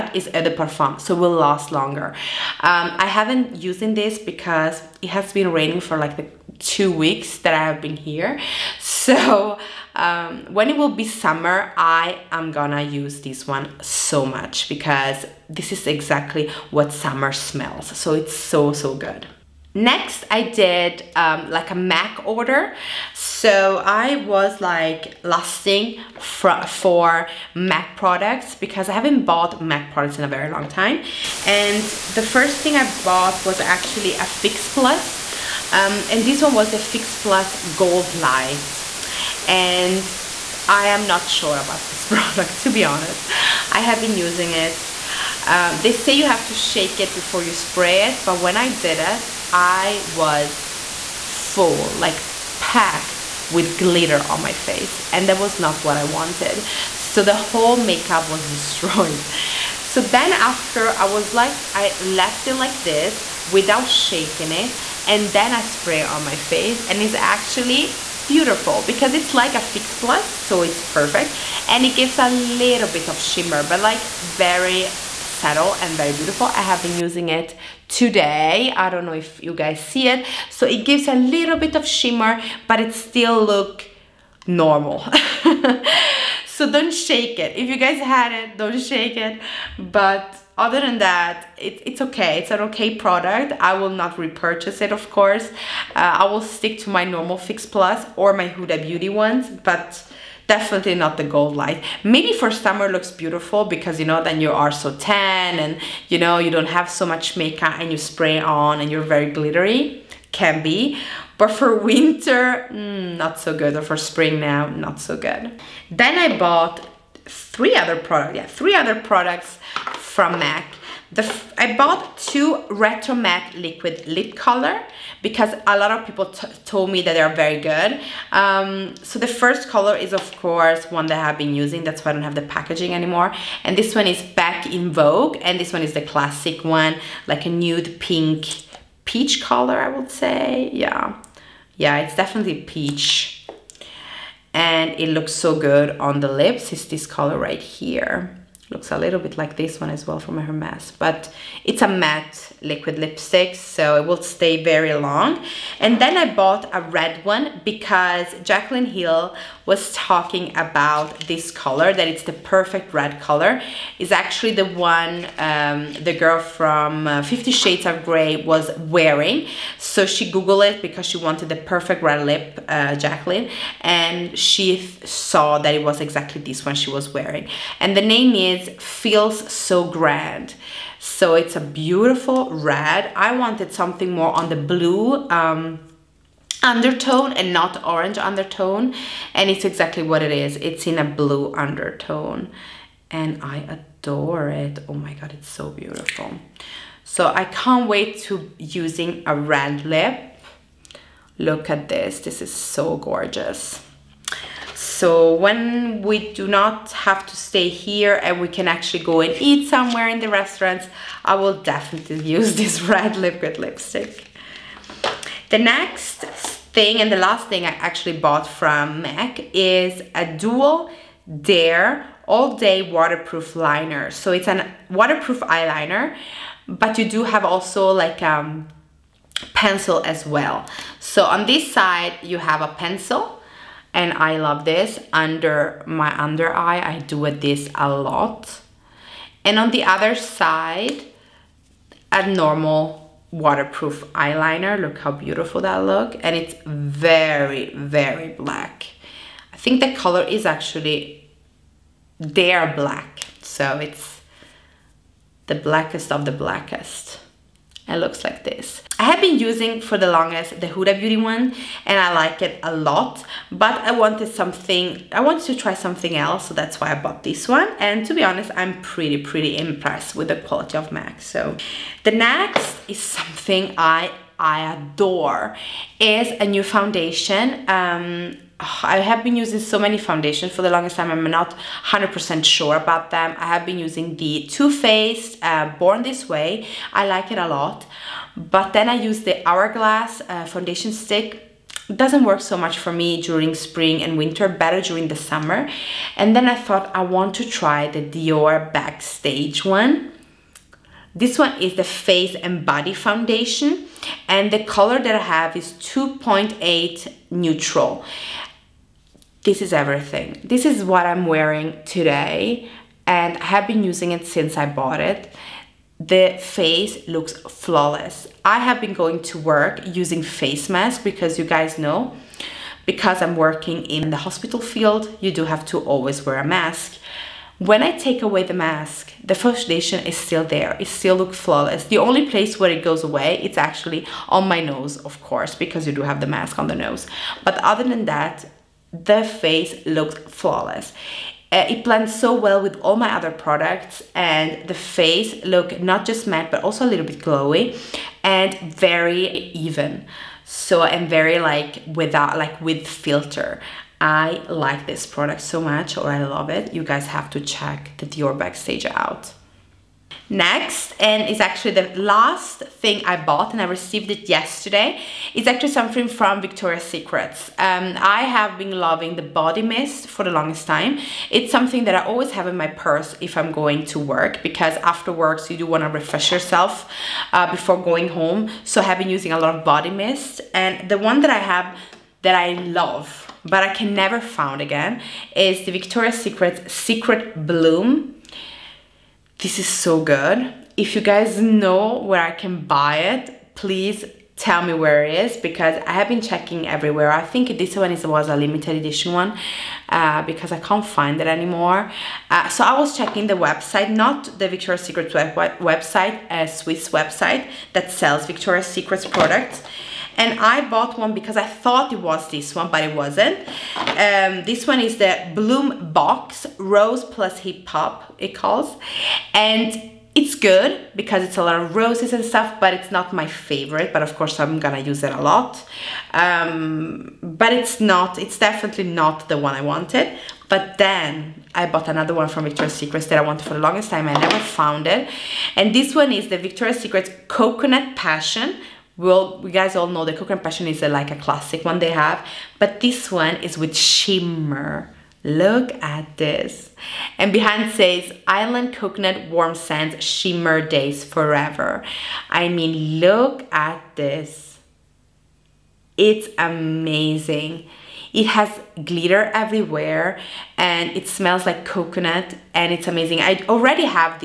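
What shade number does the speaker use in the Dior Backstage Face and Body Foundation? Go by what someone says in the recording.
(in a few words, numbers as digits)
2.8 neutral.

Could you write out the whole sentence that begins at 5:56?
You guys have to check the Dior Backstage out.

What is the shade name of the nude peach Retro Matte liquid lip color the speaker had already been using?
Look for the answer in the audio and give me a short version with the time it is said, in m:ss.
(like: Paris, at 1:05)
Back in Vogue, at 2:14.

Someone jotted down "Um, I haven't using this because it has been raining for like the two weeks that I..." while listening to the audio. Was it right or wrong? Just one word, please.
right.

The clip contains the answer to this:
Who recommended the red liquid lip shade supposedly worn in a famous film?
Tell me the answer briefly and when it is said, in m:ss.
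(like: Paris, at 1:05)
Jaclyn Hill, at 2:38.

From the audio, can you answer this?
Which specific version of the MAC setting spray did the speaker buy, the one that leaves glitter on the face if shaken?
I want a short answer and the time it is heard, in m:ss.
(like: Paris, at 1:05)
Fix Plus Gold Light, at 0:36.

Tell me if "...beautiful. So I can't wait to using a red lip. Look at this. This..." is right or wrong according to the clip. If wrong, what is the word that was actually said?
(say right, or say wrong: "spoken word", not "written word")
right.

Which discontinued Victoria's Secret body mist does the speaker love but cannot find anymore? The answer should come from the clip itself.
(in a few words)
Secret Bloom.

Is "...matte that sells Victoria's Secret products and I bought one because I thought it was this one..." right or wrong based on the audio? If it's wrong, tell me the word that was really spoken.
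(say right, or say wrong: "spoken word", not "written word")
wrong: "website", not "matte".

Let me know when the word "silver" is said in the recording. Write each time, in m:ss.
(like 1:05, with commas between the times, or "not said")
not said.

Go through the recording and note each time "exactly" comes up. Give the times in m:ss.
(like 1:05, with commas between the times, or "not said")
0:15, 2:56, 3:09.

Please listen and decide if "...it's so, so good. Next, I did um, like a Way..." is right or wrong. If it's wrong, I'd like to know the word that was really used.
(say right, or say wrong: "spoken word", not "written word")
wrong: "MAC", not "Way".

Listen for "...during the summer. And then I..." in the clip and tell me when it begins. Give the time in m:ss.
4:54.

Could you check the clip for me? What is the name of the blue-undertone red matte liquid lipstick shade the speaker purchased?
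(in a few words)
It Feels So Grand.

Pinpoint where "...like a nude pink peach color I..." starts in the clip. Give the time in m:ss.
2:17.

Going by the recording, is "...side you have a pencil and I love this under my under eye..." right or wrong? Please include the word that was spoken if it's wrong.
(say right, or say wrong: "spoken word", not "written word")
right.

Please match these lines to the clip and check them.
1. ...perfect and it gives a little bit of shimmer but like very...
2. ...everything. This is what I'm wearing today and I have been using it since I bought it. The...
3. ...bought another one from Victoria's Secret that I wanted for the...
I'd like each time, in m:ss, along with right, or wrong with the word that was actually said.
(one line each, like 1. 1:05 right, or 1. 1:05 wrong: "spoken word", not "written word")
1. 1:10 right
2. 5:09 right
3. 7:11 right.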